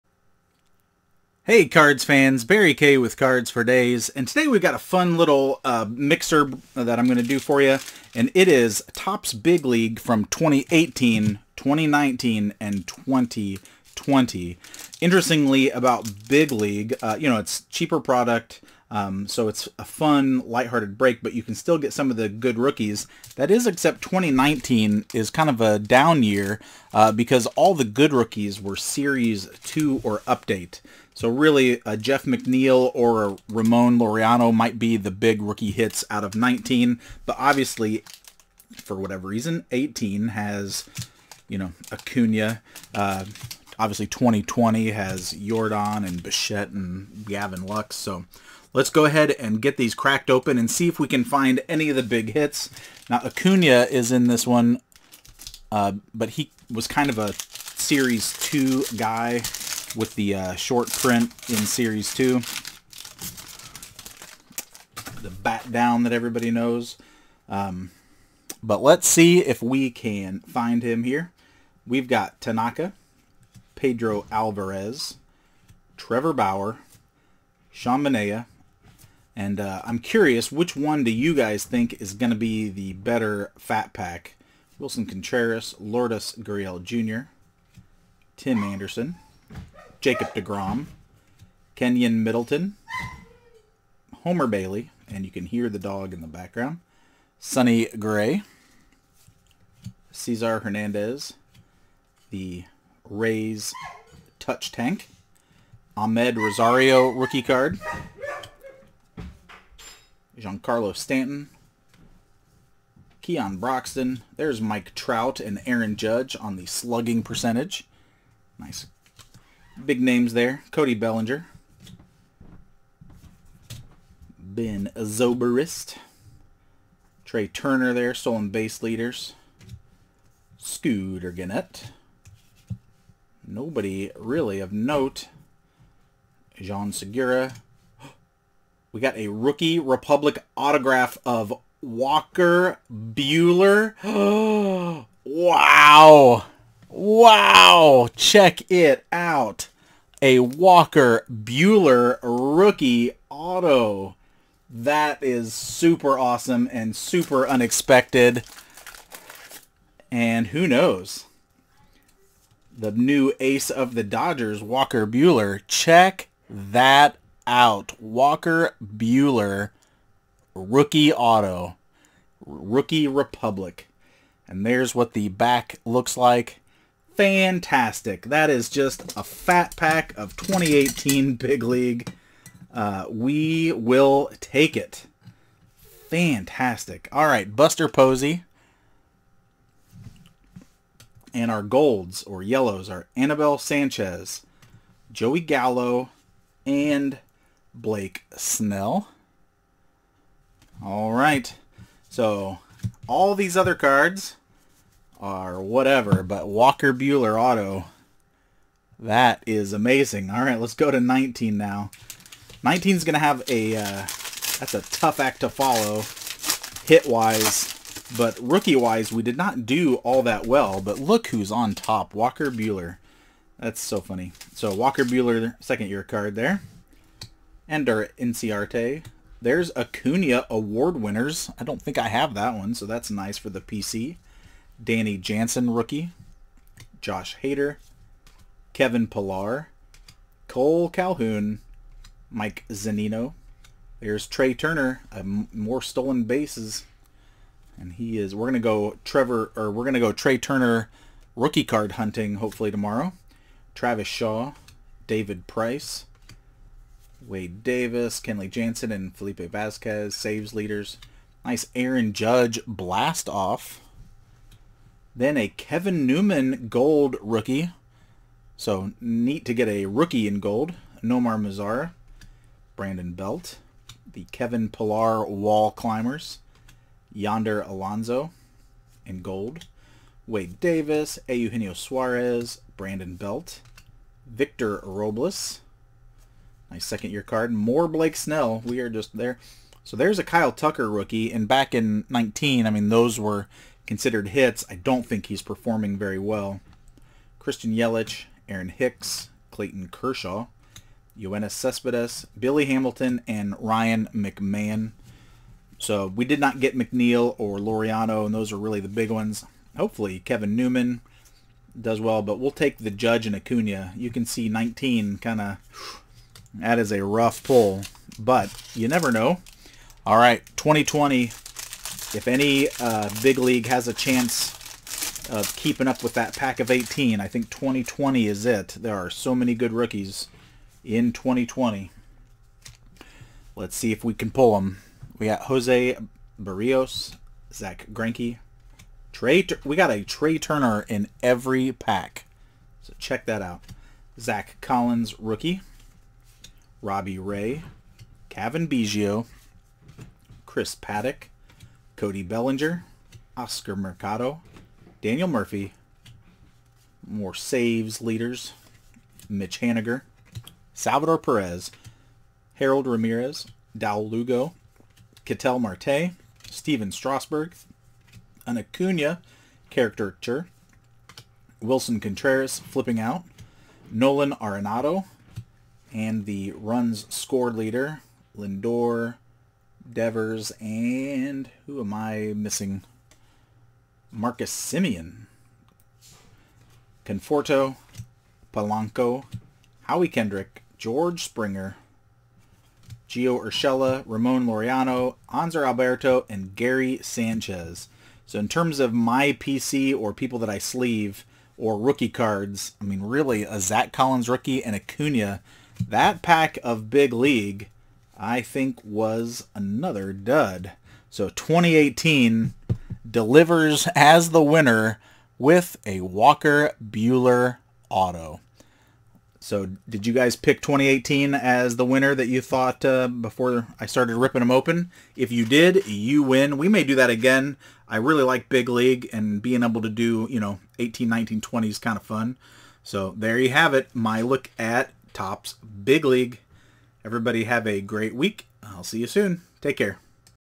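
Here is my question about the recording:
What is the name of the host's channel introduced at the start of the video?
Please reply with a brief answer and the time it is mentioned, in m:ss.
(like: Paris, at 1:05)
Cards for Daze, at 0:03.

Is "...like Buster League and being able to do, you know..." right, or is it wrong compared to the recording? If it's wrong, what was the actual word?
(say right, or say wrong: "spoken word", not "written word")
wrong: "Big", not "Buster".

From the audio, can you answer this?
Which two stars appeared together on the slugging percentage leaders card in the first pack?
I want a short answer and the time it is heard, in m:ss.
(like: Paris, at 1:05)
Mike Trout and Aaron Judge, at 1:54.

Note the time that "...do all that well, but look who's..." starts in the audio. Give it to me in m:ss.
3:39.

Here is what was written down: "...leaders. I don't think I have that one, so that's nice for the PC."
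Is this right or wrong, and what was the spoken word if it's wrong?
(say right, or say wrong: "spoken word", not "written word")
wrong: "winners", not "leaders".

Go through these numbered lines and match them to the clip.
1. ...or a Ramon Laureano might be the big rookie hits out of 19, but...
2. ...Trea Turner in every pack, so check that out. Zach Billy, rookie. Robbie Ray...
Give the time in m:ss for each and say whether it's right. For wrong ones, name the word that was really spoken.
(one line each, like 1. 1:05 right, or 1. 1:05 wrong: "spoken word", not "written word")
1. 0:32 right
2. 5:40 wrong: "Collins", not "Billy".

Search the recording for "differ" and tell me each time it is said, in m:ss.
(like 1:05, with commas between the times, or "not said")
not said.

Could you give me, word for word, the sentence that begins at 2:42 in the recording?
The new ace of the Dodgers, Walker Buehler.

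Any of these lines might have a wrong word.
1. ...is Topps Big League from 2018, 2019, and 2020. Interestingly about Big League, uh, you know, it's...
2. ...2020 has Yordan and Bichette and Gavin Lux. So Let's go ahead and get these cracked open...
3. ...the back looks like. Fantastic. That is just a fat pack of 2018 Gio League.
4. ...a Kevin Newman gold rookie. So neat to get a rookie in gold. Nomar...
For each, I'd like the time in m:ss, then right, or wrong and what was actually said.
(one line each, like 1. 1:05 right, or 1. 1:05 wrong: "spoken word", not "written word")
1. 0:08 right
2. 0:44 right
3. 2:55 wrong: "Big", not "Gio"
4. 4:25 right.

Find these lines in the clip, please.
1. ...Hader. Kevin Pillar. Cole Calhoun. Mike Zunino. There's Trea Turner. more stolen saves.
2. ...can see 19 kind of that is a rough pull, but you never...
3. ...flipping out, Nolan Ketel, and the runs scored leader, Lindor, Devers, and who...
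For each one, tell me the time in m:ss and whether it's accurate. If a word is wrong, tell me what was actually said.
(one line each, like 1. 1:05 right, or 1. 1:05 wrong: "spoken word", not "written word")
1. 3:57 wrong: "bases", not "saves"
2. 5:14 right
3. 6:12 wrong: "Arenado", not "Ketel".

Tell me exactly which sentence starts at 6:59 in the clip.
So did you guys pick 2018 as the winner that you thought uh, before I started ripping them open?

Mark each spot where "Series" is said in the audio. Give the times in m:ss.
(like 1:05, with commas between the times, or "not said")
0:28, 0:57, 1:01.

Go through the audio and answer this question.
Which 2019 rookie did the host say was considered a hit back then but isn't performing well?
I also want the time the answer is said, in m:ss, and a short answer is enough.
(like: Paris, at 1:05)
Kyle Tucker, at 4:50.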